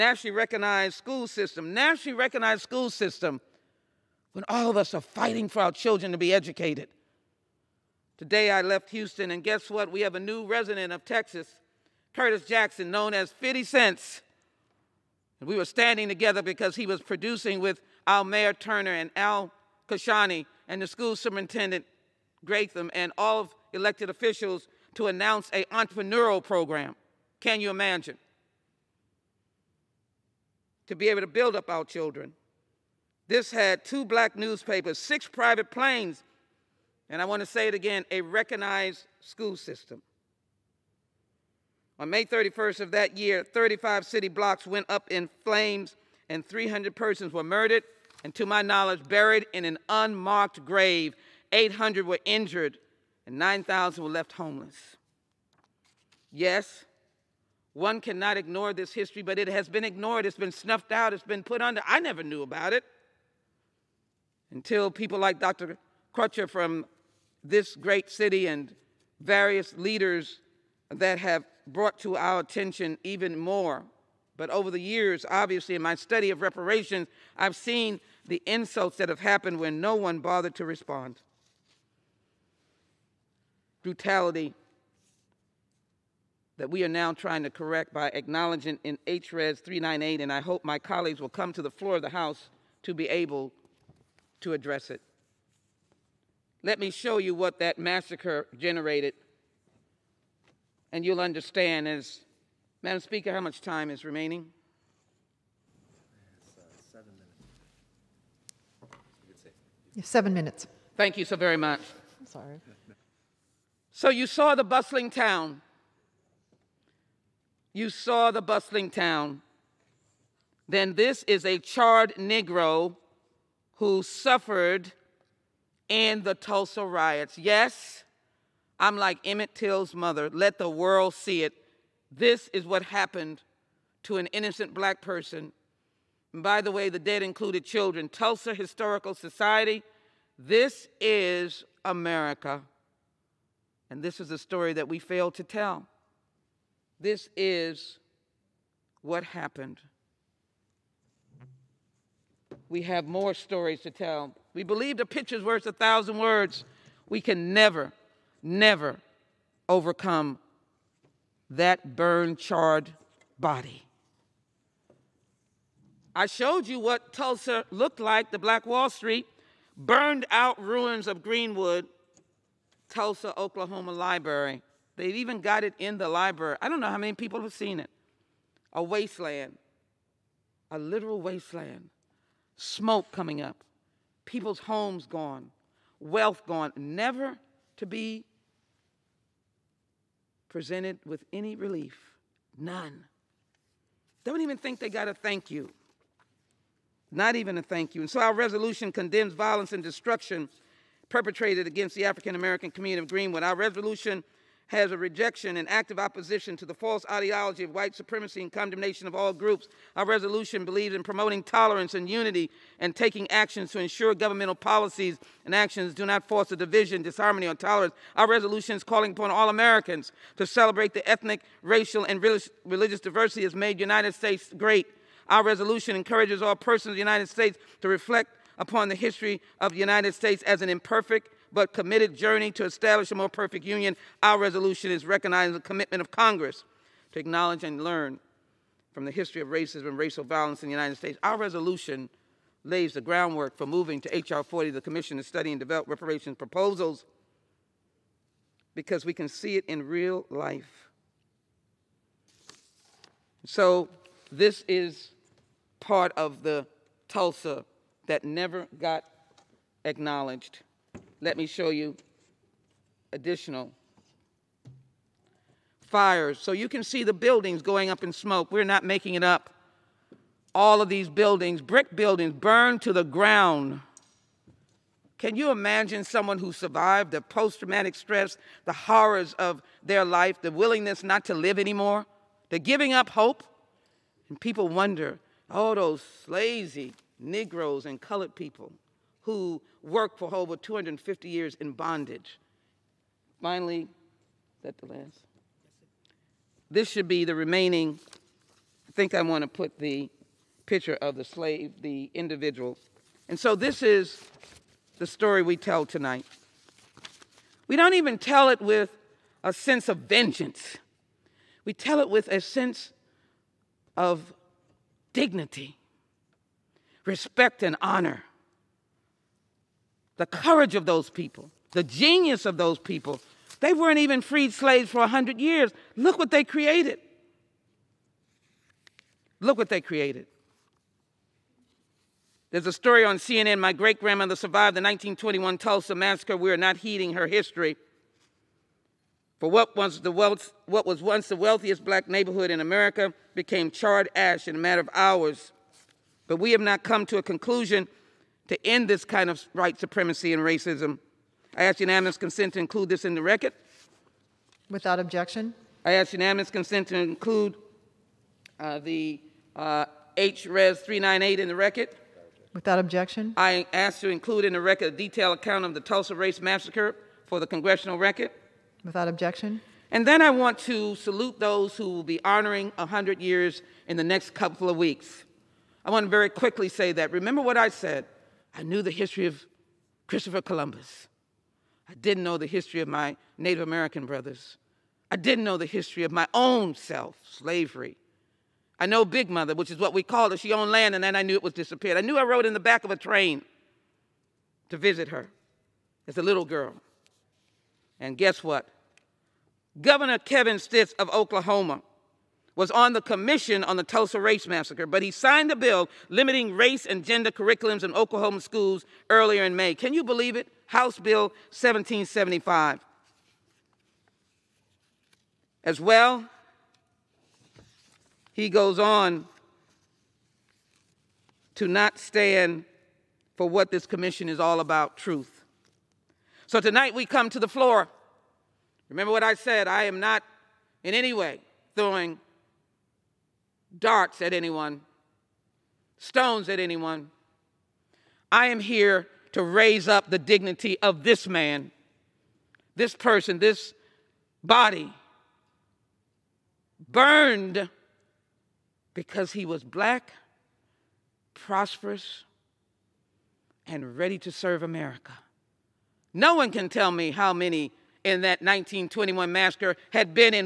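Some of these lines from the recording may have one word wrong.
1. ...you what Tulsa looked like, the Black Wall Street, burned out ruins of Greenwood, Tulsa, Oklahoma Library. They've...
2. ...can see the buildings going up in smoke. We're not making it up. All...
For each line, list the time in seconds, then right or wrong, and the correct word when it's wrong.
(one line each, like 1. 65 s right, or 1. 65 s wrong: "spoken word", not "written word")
1. 166 s right
2. 266 s right.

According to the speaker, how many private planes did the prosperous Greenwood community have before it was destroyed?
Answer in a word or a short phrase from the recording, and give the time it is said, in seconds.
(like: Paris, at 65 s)
6, at 34 s.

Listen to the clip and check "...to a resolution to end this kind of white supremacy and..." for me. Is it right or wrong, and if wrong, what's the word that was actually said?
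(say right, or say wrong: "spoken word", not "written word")
wrong: "conclusion", not "resolution".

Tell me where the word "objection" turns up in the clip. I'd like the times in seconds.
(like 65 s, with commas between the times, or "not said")
354 s, 362 s, 369 s.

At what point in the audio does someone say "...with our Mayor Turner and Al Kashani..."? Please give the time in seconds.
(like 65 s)
17 s.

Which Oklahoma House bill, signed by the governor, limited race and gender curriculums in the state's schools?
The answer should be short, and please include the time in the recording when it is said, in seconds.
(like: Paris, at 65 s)
House Bill 1775, at 410 s.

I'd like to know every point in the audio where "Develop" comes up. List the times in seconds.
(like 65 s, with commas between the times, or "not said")
245 s.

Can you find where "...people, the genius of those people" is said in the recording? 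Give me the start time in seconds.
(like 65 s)
321 s.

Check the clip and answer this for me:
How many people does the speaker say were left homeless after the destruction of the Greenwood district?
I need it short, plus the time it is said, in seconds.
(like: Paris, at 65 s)
9,000, at 53 s.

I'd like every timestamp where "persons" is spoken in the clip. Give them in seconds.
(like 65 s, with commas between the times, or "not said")
46 s, 135 s, 226 s, 442 s.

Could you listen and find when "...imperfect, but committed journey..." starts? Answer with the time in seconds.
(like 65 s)
230 s.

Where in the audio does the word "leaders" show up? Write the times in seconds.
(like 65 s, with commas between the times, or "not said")
69 s.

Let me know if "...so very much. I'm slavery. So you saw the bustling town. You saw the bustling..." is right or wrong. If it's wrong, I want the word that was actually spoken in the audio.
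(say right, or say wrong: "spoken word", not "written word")
wrong: "sorry", not "slavery".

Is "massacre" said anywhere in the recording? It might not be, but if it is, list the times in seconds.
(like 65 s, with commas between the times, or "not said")
97 s, 335 s, 366 s, 404 s, 459 s.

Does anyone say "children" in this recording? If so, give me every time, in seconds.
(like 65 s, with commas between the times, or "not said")
5 s, 31 s, 137 s.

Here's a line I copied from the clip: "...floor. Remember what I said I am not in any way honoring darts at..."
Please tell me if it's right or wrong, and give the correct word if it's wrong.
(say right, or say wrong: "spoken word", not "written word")
wrong: "throwing", not "honoring".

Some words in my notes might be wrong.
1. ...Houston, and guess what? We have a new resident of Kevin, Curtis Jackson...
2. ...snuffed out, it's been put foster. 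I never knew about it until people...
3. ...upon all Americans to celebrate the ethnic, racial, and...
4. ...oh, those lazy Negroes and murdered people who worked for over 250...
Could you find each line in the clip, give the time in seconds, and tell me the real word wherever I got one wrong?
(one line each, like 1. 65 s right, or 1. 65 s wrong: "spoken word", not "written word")
1. 8 s wrong: "Texas", not "Kevin"
2. 60 s wrong: "under", not "foster"
3. 219 s right
4. 285 s wrong: "colored", not "murdered".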